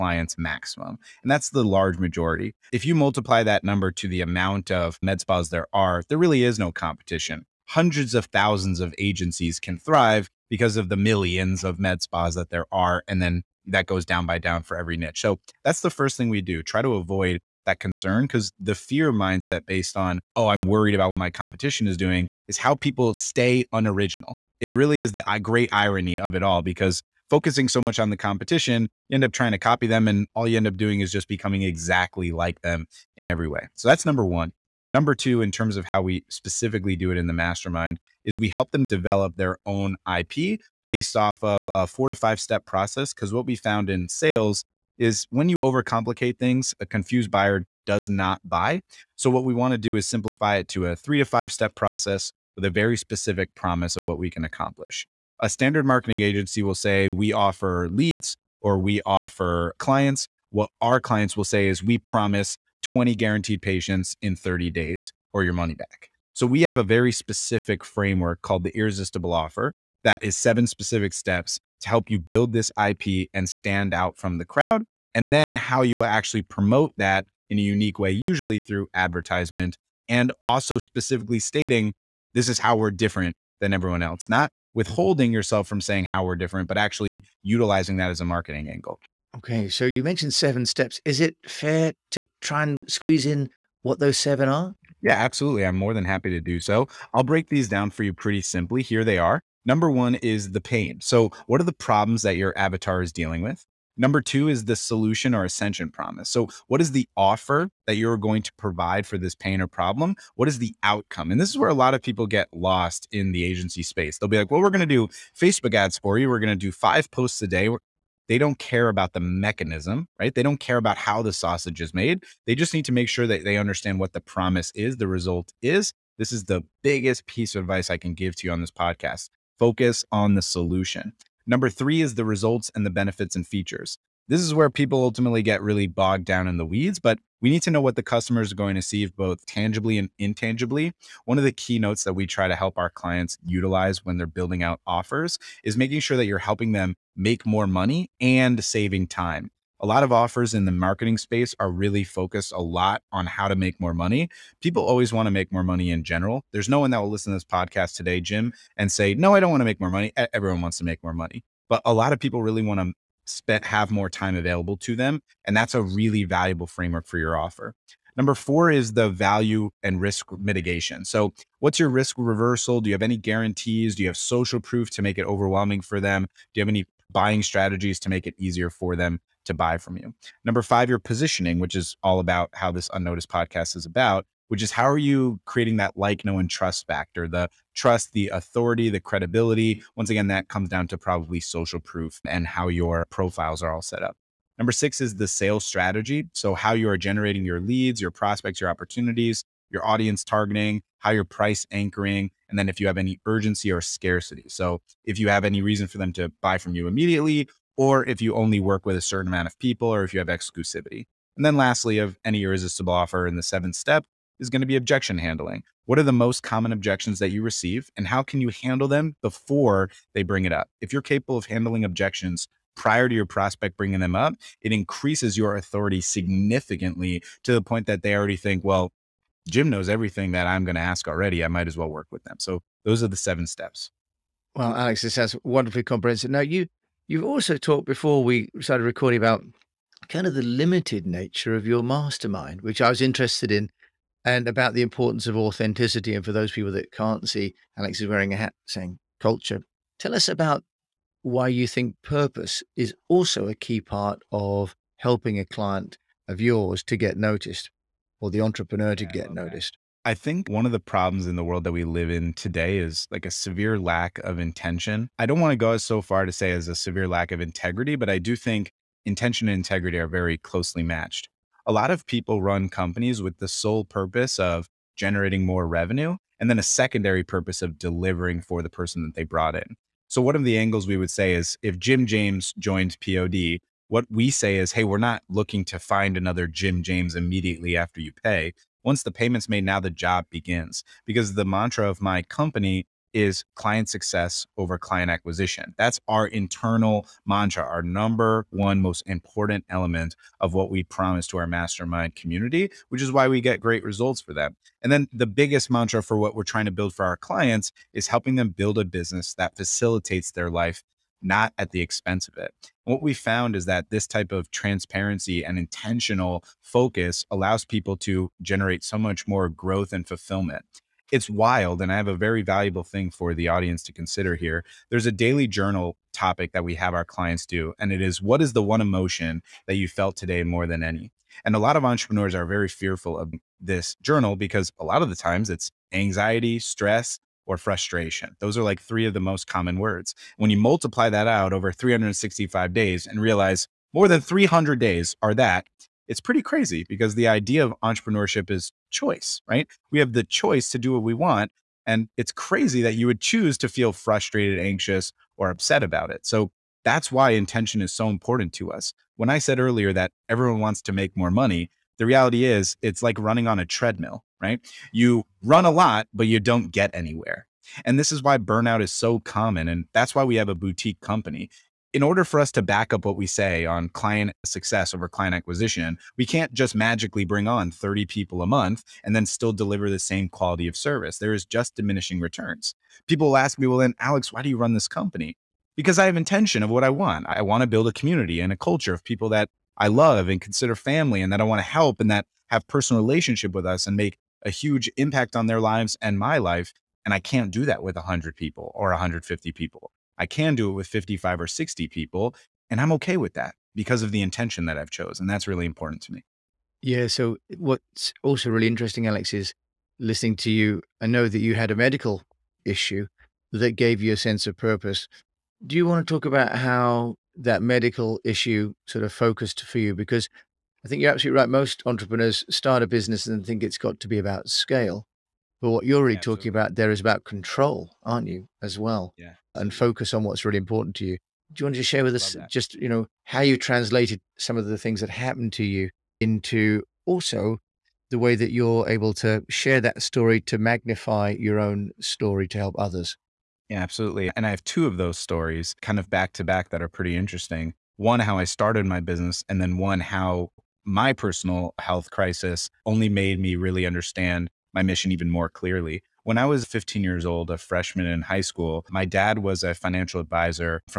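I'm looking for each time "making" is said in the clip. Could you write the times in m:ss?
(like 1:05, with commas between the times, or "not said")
2:25.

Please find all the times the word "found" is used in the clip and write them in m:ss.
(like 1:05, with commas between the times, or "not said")
0:43, 5:13.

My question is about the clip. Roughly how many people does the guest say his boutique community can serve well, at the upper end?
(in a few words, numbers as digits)
60.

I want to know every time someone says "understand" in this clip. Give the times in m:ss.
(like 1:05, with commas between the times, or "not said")
2:03, 7:33.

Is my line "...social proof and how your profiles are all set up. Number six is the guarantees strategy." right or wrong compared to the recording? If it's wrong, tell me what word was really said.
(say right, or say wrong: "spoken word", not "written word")
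wrong: "sales", not "guarantees".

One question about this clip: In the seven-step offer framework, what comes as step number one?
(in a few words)
The pain.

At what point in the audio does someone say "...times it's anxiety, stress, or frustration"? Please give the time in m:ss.
5:35.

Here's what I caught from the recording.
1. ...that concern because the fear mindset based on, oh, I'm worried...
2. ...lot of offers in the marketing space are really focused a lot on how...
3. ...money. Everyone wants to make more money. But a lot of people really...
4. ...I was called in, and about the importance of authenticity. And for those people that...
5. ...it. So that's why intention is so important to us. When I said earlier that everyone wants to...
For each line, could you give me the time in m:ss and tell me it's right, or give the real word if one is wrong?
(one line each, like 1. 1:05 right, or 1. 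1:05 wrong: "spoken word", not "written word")
1. 0:17 right
2. 2:29 right
3. 2:39 right
4. 4:02 wrong: "interested", not "called"
5. 5:56 right.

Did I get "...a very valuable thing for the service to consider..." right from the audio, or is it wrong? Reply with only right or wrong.
wrong.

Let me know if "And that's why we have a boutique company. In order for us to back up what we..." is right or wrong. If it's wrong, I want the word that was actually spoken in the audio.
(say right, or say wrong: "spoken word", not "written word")
right.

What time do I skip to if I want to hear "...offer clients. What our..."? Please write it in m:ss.
0:59.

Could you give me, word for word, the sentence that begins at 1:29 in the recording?
Okay, so you mentioned seven steps.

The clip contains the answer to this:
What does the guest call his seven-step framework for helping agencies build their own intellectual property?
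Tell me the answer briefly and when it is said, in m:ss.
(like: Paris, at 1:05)
The irresistible offer, at 1:08.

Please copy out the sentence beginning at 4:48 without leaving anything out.
Once the payment's made, now the job begins.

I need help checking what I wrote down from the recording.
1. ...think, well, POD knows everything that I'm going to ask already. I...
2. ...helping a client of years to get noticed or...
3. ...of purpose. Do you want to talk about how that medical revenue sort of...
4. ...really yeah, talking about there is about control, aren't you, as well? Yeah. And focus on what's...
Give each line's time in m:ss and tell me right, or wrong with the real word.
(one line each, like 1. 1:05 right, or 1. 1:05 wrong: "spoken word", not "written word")
1. 3:48 wrong: "Jim", not "POD"
2. 4:14 wrong: "yours", not "years"
3. 6:54 wrong: "issue", not "revenue"
4. 7:06 right.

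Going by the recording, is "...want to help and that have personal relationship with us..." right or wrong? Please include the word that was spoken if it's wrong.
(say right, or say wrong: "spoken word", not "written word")
right.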